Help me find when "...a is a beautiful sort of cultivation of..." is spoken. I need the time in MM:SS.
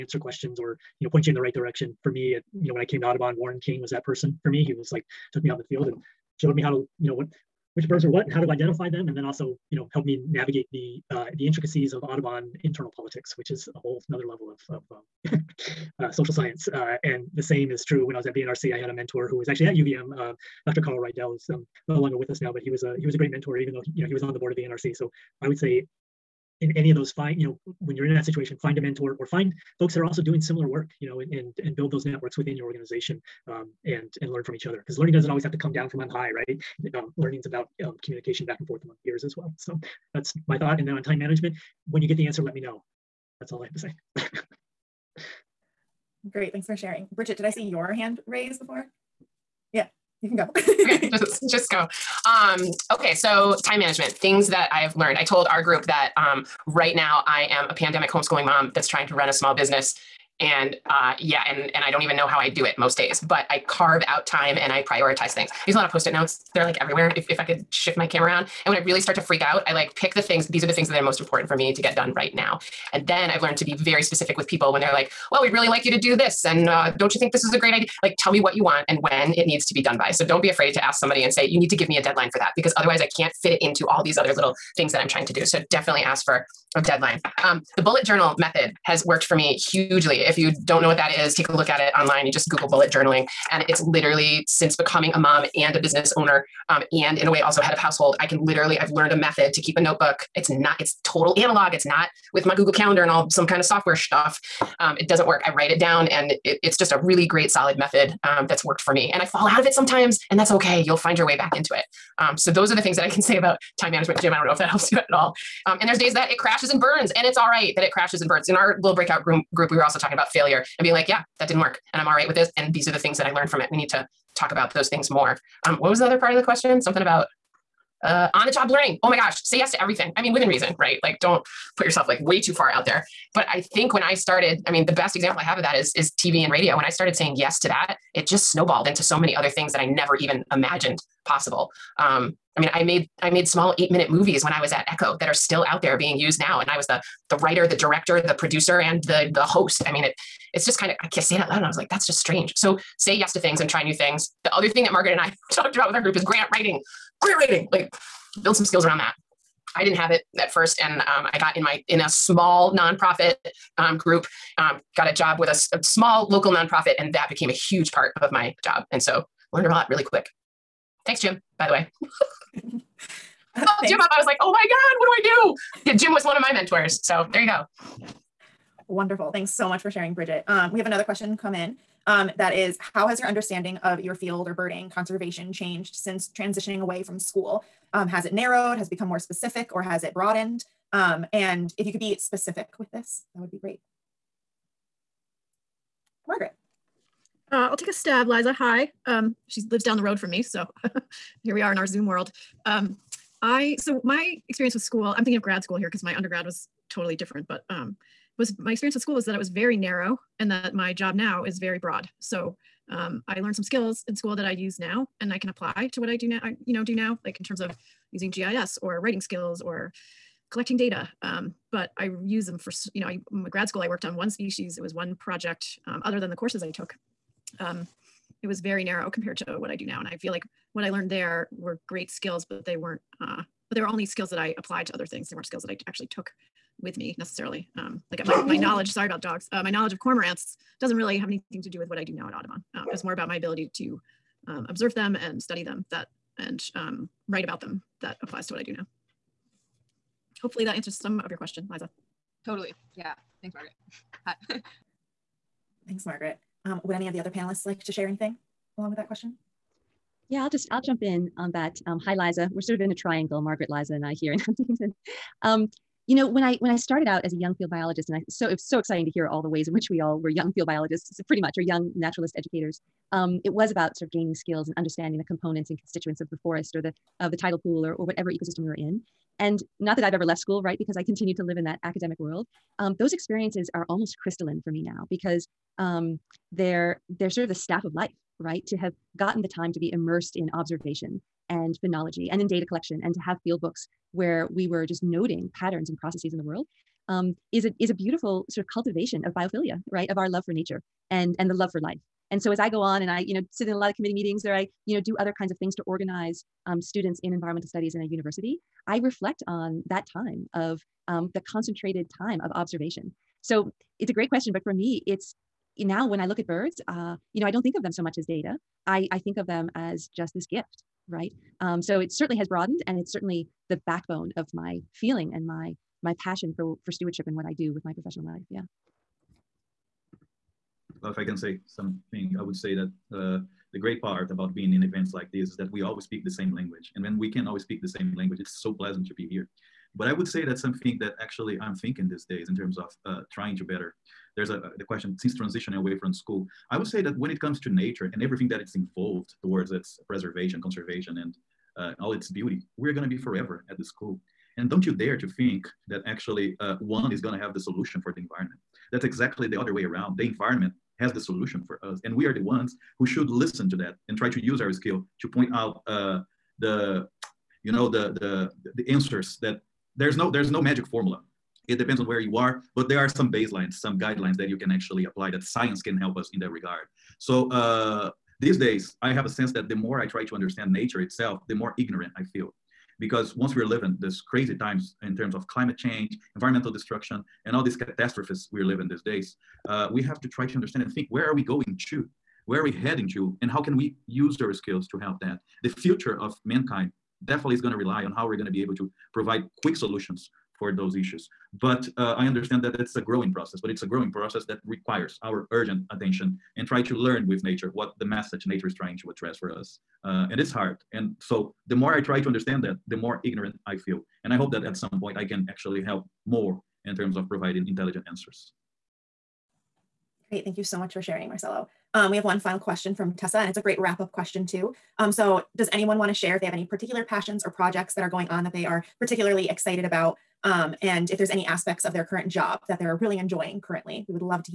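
04:57.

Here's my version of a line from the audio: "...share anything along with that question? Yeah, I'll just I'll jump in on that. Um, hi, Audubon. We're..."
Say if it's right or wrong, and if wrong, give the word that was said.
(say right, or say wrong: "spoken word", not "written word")
wrong: "Liza", not "Audubon".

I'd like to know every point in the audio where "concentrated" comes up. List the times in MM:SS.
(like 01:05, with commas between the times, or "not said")
05:11.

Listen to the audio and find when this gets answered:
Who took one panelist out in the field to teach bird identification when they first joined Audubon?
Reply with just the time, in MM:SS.
00:03.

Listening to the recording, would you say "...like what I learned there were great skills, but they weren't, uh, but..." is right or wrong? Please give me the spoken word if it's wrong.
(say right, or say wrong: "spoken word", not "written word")
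right.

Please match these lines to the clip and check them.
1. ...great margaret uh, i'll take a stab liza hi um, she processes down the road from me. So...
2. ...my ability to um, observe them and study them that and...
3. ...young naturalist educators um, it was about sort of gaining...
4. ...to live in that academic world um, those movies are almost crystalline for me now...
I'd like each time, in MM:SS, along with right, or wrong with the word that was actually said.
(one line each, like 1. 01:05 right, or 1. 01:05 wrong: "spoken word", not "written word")
1. 03:13 wrong: "lives", not "processes"
2. 04:03 right
3. 04:31 right
4. 04:41 wrong: "experiences", not "movies".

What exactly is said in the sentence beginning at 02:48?
And so learned a lot really quick.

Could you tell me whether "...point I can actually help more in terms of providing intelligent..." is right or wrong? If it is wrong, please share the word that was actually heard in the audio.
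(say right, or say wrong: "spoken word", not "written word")
right.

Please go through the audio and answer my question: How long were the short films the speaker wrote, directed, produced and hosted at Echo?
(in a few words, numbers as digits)
8 minutes.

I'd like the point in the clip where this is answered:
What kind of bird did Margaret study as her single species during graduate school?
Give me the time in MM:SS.
03:59.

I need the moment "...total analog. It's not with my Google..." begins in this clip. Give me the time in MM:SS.
01:41.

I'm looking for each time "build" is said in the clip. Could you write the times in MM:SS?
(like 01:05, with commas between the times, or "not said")
00:31, 02:38.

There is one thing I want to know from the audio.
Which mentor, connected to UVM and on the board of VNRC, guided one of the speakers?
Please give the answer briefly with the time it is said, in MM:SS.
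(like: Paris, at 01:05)
Dr. Carl Reidel, at 00:20.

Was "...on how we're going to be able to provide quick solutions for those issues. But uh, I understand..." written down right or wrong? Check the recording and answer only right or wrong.
right.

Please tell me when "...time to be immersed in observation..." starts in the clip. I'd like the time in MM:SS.
04:49.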